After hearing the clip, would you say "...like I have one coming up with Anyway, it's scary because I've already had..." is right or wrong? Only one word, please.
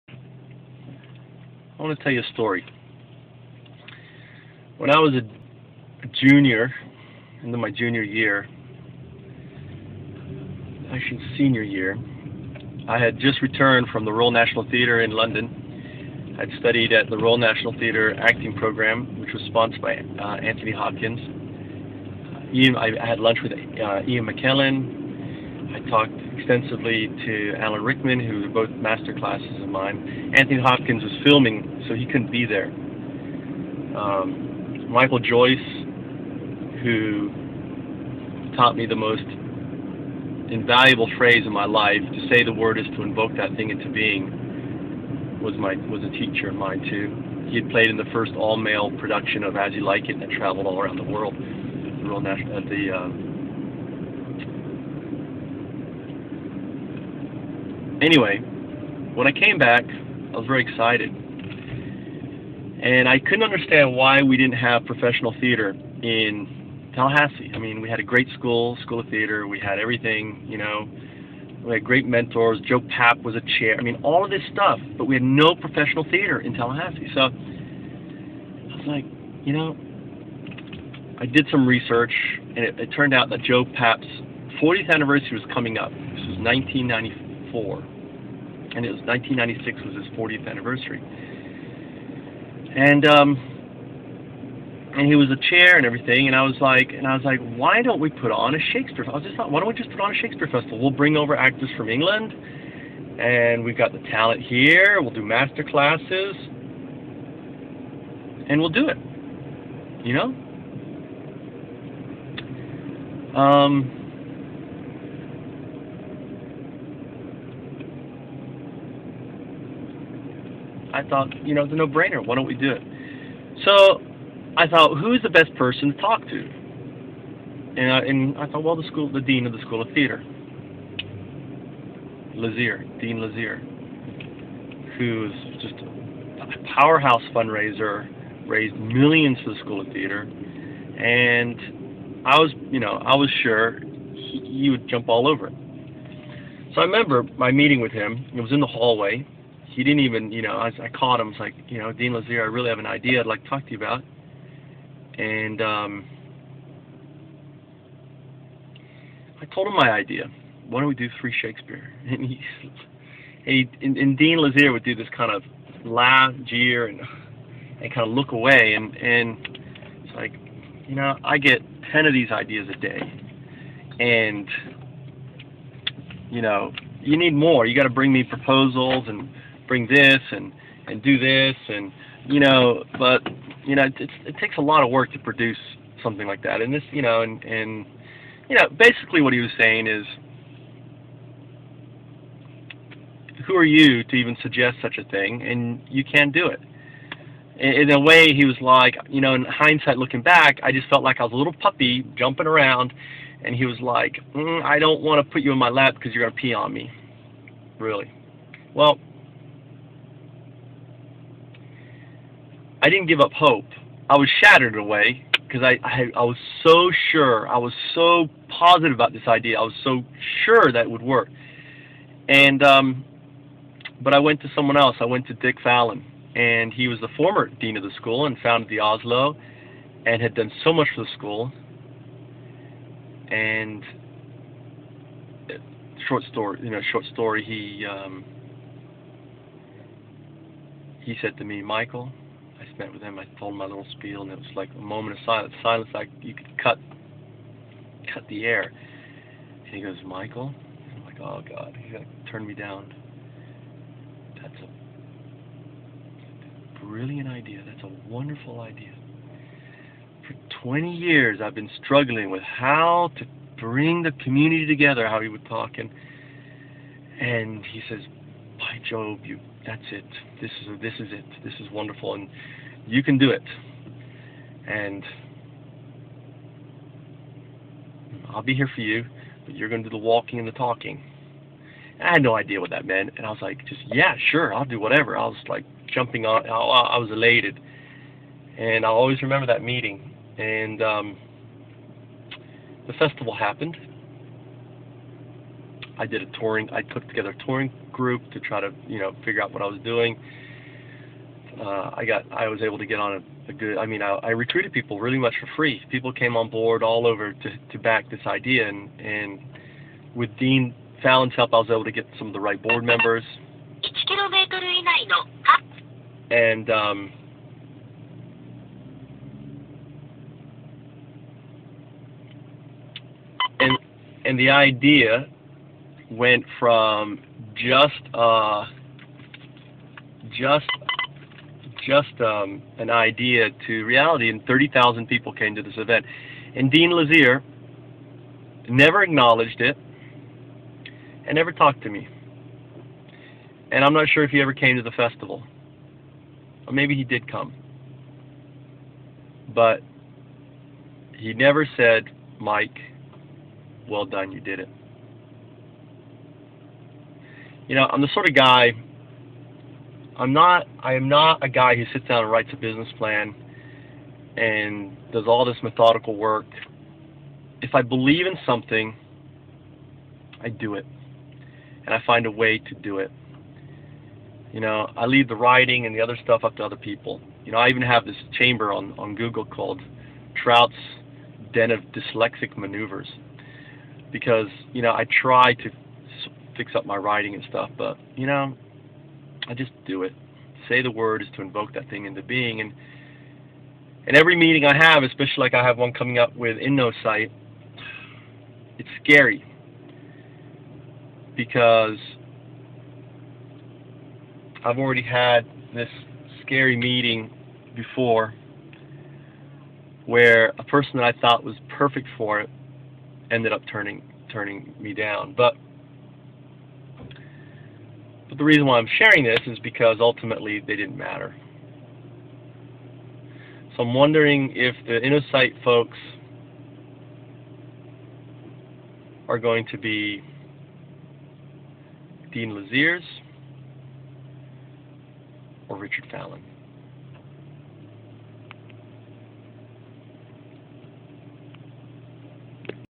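wrong.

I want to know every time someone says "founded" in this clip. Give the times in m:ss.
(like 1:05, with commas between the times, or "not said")
3:48.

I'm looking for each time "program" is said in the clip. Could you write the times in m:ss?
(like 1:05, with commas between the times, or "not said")
0:18.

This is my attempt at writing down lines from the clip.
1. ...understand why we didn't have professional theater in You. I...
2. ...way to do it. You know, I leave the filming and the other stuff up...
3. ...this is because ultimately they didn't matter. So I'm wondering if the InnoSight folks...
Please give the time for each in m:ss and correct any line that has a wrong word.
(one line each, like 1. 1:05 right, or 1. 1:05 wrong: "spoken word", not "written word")
1. 1:03 wrong: "Tallahassee", not "You"
2. 6:12 wrong: "writing", not "filming"
3. 6:59 right.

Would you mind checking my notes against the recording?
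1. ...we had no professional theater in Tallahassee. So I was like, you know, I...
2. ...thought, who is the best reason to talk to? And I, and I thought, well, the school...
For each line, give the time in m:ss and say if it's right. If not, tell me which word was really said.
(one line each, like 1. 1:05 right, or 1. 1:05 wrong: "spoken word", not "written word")
1. 1:15 right
2. 2:04 wrong: "person", not "reason".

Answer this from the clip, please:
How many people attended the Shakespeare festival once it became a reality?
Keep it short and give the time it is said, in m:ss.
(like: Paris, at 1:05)
30,000, at 5:34.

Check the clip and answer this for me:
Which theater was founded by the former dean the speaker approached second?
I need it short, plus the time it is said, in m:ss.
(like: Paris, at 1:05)
the Asolo, at 3:48.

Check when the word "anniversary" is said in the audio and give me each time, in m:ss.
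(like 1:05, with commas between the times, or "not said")
1:24, 1:30.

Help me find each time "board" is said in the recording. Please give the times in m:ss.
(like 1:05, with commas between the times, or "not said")
5:06, 5:12.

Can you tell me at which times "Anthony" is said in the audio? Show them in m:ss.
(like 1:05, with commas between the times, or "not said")
0:20, 0:30.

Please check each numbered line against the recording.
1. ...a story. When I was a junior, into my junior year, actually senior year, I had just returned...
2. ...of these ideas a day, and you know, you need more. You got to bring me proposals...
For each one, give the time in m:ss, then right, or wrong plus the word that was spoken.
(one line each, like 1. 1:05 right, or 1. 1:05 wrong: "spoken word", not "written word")
1. 0:02 right
2. 2:52 right.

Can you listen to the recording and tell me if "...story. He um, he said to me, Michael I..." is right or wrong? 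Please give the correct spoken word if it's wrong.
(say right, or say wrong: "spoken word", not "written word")
right.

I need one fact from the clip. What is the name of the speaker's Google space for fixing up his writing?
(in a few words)
Trout's Den of Dyslexic Maneuvers.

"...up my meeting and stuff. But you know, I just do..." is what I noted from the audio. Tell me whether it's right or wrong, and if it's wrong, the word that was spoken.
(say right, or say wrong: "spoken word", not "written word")
wrong: "writing", not "meeting".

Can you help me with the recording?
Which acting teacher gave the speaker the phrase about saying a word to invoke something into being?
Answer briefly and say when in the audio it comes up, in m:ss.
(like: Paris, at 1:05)
Michael Joyce, at 0:34.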